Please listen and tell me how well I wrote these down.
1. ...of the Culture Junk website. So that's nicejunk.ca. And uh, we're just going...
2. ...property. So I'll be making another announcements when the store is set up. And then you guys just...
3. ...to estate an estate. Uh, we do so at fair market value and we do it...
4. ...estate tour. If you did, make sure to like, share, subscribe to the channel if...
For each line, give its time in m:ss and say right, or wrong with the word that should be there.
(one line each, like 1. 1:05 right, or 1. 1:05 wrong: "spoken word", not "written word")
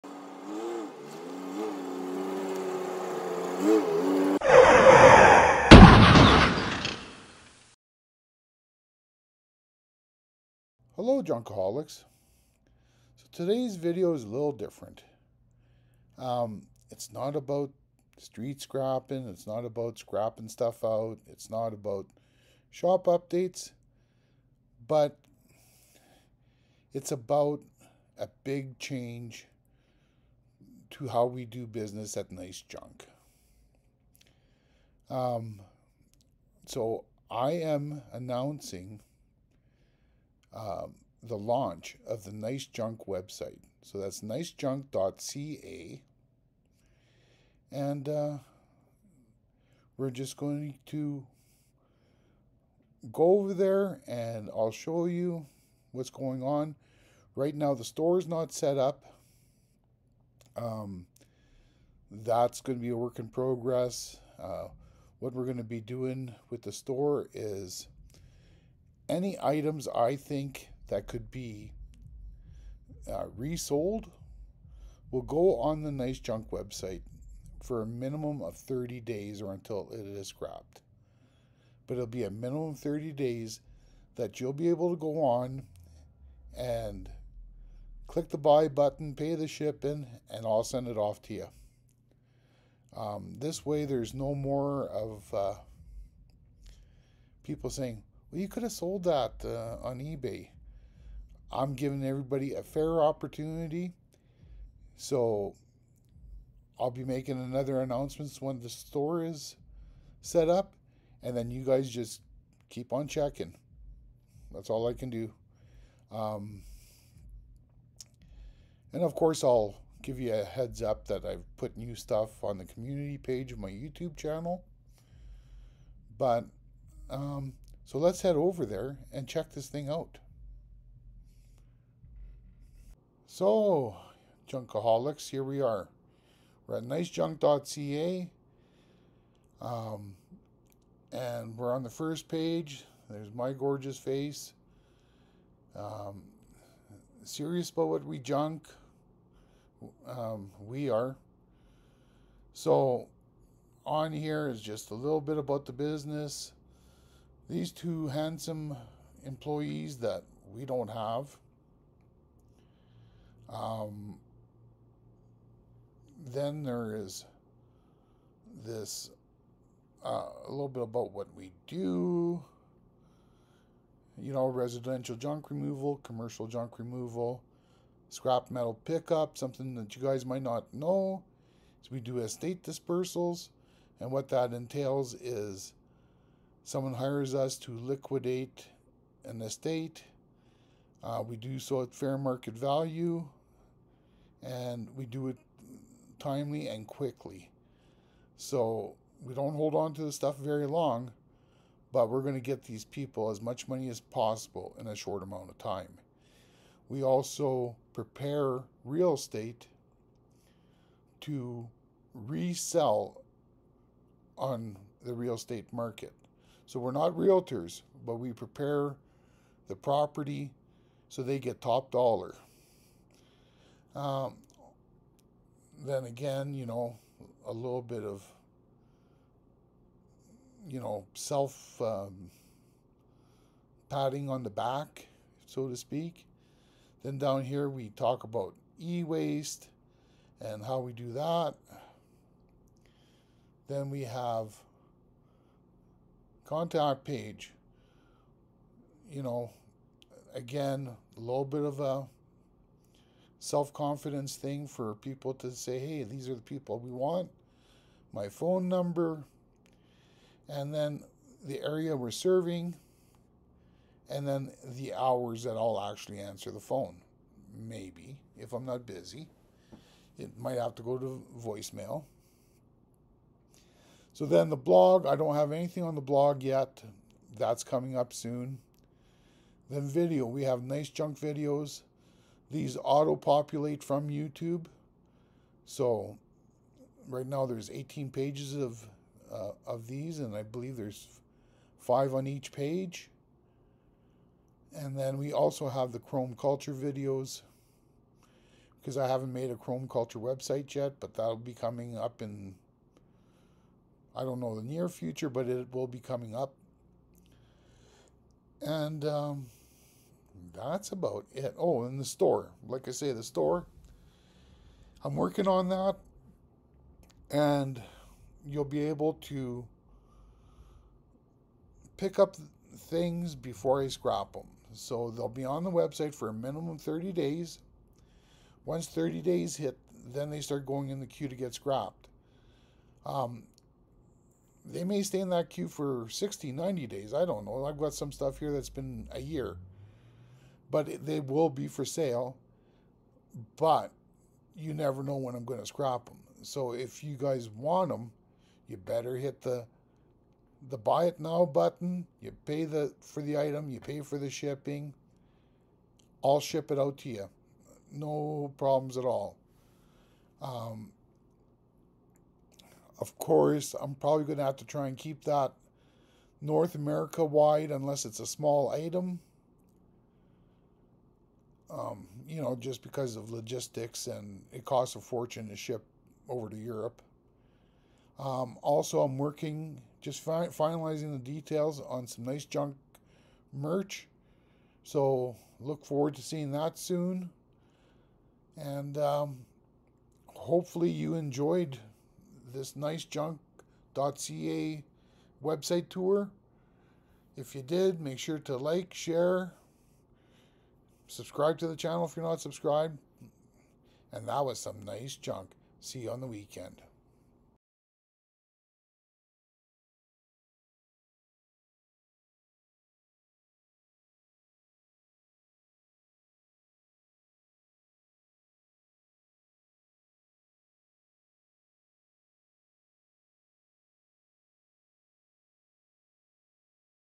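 1. 0:42 wrong: "Nice", not "Culture"
2. 1:43 wrong: "opportunity", not "property"
3. 3:07 wrong: "liquidate", not "estate"
4. 6:35 wrong: "website", not "estate".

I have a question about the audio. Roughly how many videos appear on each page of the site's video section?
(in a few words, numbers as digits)
5.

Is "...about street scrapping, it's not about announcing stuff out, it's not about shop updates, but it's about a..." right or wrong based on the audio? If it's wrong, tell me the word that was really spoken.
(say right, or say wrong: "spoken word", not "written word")
wrong: "scrapping", not "announcing".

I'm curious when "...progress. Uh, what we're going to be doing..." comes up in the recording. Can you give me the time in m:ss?
1:03.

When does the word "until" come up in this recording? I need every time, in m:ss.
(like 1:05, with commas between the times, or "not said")
1:19.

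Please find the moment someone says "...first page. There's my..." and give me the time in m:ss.
2:21.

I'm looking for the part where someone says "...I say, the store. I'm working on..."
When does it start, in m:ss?
5:12.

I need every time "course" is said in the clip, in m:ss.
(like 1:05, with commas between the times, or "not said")
1:59, 6:03.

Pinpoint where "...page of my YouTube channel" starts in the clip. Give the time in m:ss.
2:03.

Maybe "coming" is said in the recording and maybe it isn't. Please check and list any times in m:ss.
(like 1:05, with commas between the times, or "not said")
4:37, 5:01, 5:05.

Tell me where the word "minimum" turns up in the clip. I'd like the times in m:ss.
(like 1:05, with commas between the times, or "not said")
1:17, 1:22, 5:26.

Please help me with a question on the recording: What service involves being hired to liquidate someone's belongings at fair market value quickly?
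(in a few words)
Estate dispersals.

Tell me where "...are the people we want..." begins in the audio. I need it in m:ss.
4:16.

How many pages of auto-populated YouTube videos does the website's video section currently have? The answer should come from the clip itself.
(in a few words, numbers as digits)
18.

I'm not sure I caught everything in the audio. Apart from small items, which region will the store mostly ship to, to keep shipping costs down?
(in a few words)
North America.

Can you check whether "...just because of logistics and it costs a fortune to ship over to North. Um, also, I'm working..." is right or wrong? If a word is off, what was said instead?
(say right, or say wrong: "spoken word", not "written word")
wrong: "Europe", not "North".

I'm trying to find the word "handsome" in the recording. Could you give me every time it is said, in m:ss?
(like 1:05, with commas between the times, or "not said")
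2:38.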